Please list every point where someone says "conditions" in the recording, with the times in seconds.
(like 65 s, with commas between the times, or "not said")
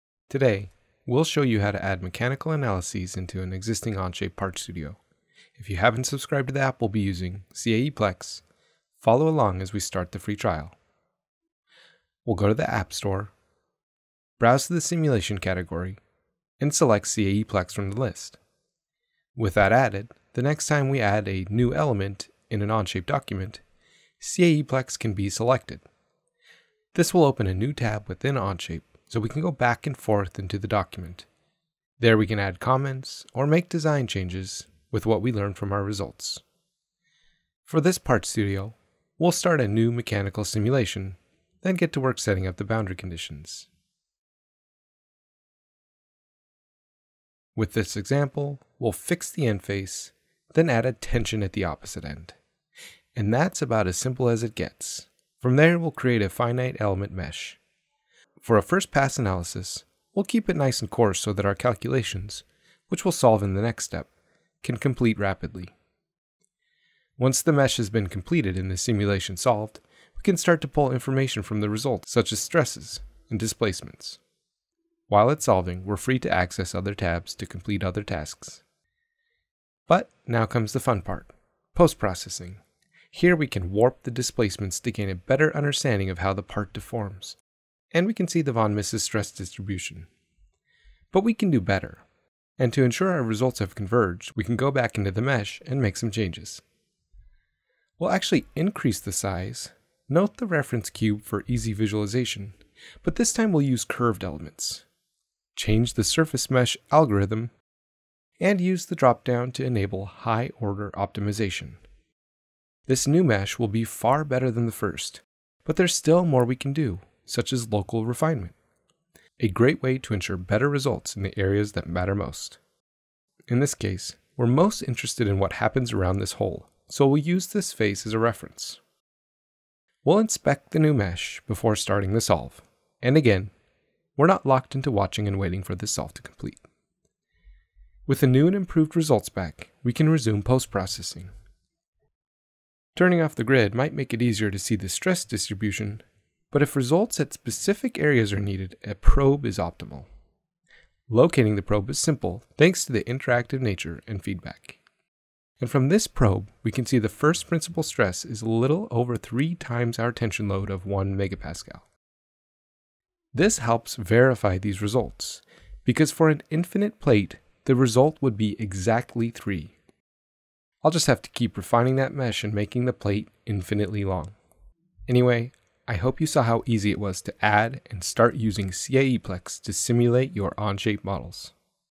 42 s.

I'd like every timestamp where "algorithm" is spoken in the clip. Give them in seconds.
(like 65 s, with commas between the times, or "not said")
106 s.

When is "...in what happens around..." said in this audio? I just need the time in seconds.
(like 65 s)
125 s.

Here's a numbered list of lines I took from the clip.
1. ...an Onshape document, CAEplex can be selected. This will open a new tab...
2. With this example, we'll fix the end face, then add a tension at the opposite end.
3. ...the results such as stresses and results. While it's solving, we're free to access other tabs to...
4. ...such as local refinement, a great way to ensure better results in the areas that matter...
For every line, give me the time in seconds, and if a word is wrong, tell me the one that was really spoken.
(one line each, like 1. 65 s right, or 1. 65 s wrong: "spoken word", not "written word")
1. 22 s right
2. 47 s right
3. 71 s wrong: "displacements", not "results"
4. 117 s right.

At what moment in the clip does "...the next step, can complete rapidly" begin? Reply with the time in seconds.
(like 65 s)
63 s.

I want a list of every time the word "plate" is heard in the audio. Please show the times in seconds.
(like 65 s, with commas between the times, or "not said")
166 s, 172 s.